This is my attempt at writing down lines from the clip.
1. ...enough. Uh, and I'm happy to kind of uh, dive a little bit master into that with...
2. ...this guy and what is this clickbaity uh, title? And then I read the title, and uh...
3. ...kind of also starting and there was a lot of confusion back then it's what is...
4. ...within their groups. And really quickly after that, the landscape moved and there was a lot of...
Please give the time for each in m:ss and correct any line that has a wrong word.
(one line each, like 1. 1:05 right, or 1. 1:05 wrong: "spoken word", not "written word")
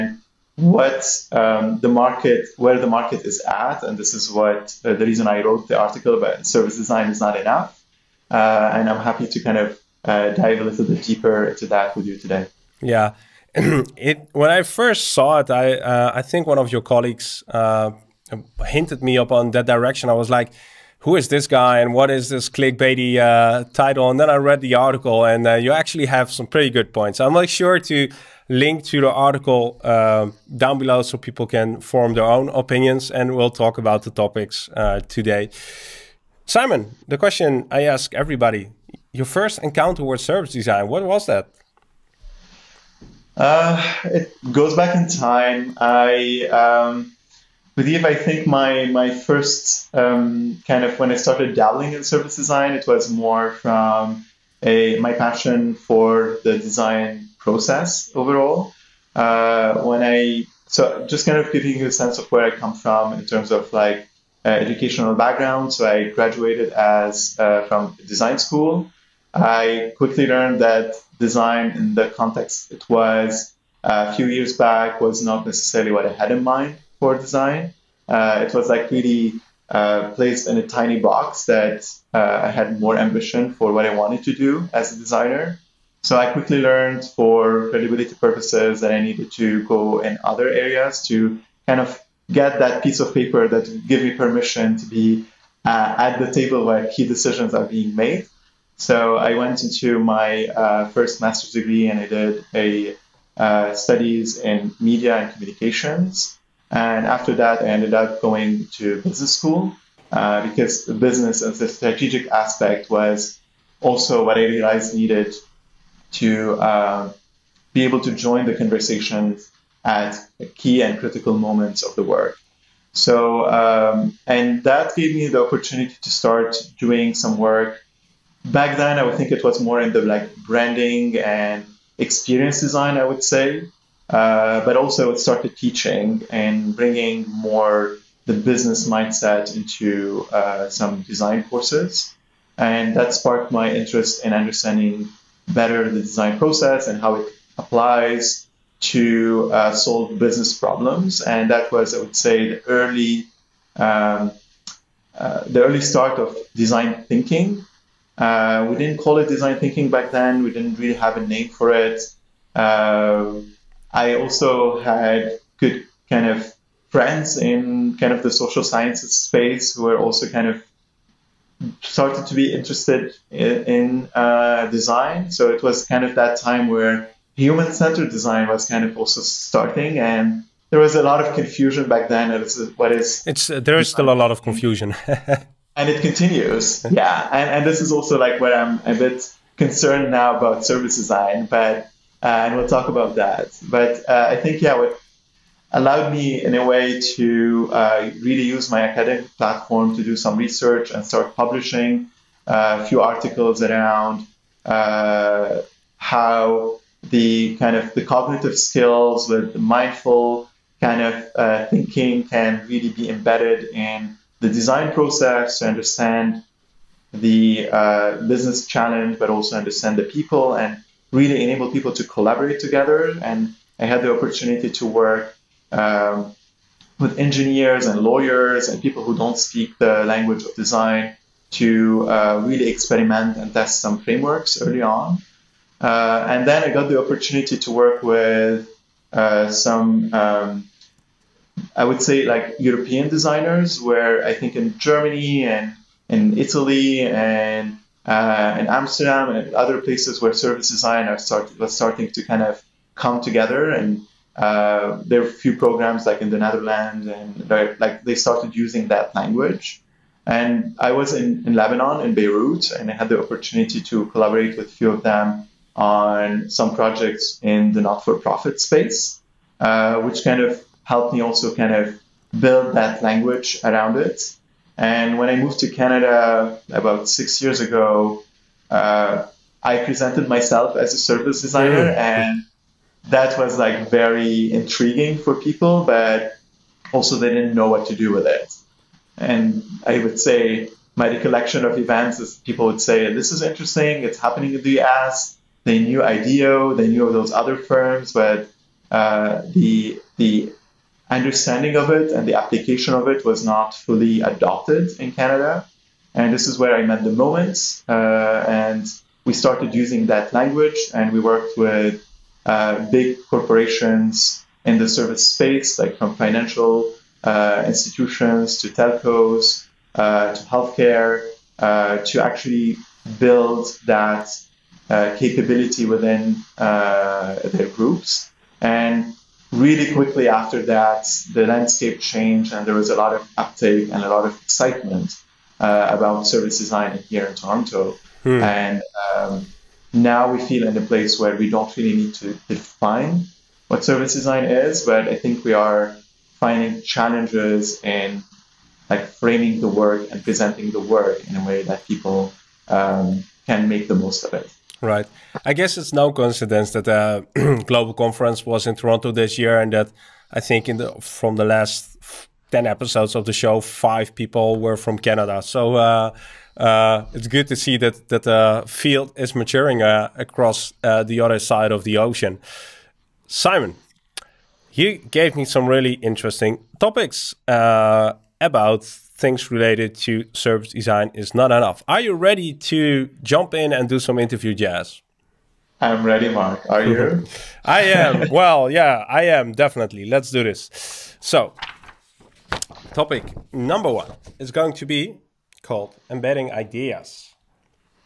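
1. 0:07 wrong: "deeper", not "master"
2. 0:21 wrong: "article", not "title"
3. 2:58 right
4. 5:25 wrong: "changed", not "moved".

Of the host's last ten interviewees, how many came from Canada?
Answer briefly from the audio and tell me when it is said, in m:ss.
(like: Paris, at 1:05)
5, at 6:03.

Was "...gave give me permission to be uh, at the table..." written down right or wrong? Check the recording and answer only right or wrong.
right.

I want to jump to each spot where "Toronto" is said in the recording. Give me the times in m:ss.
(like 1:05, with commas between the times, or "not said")
5:37, 5:58.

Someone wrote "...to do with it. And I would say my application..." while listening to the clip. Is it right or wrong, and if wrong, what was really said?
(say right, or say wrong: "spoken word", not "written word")
wrong: "recollection", not "application".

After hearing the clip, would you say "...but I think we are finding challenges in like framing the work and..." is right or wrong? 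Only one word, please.
right.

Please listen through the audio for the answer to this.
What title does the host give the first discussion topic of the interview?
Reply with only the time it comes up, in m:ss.
6:36.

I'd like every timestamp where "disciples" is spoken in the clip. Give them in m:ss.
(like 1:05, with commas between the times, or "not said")
not said.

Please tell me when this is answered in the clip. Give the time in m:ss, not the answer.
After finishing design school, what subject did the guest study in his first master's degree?
1:44.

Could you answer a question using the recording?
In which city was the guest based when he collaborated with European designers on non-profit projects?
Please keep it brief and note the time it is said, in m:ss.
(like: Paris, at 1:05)
Beirut, at 4:22.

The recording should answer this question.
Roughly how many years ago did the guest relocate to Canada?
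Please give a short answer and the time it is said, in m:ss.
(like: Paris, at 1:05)
6 years, at 4:37.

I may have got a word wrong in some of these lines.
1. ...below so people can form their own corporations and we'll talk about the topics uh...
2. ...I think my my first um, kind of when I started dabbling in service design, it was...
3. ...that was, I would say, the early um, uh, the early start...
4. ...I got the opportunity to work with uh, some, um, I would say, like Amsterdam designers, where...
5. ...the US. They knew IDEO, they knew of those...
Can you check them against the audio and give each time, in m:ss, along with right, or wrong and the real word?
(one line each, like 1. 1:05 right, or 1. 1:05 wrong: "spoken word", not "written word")
1. 0:30 wrong: "opinions", not "corporations"
2. 0:48 right
3. 2:31 right
4. 3:56 wrong: "European", not "Amsterdam"
5. 4:54 right.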